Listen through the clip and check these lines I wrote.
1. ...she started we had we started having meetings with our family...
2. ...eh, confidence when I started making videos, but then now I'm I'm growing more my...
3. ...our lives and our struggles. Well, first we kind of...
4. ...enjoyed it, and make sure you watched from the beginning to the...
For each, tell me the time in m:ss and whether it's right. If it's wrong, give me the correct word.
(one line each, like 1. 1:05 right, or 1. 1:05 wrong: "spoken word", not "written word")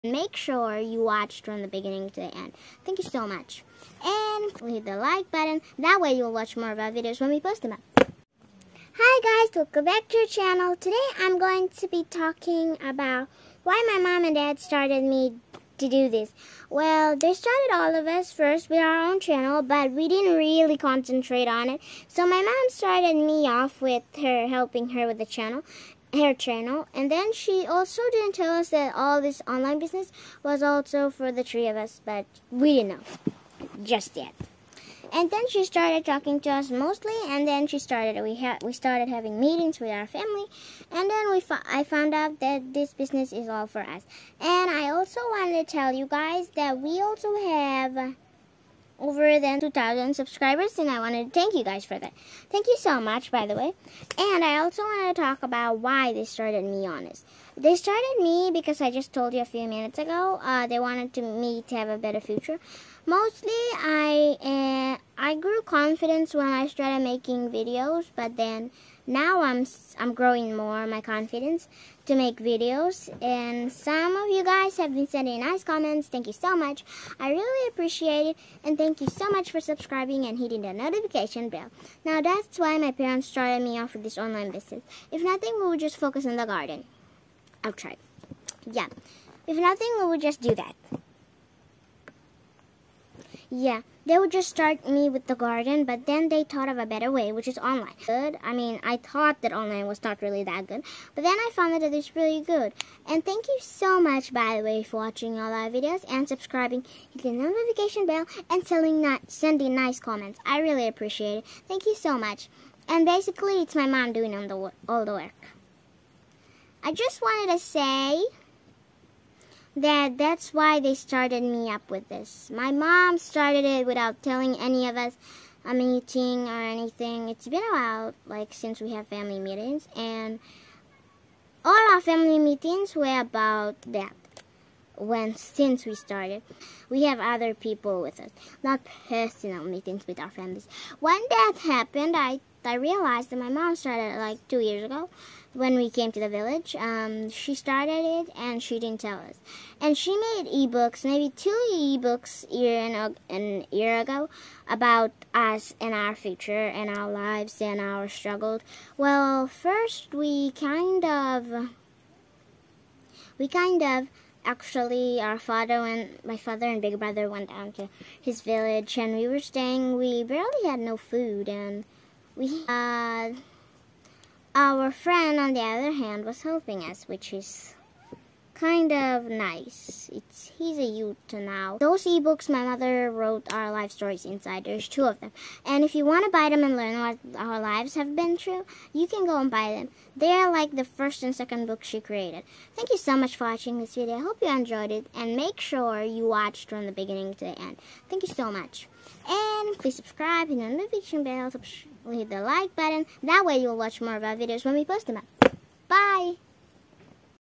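1. 0:37 right
2. 1:04 right
3. 2:36 right
4. 3:14 right.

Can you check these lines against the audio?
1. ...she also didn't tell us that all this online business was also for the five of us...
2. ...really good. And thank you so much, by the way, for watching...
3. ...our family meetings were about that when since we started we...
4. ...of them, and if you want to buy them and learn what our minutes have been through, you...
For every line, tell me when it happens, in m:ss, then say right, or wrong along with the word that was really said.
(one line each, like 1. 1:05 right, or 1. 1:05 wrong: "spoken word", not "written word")
1. 0:27 wrong: "three", not "five"
2. 1:42 right
3. 2:11 right
4. 3:05 wrong: "lives", not "minutes".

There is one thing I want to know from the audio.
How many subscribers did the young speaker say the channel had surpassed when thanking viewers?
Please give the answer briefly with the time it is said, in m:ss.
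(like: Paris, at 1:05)
2,000, at 0:49.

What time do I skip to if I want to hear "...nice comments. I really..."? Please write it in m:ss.
1:49.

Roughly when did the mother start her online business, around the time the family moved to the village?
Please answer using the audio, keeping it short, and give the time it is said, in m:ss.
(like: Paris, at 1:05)
2 years ago, at 2:24.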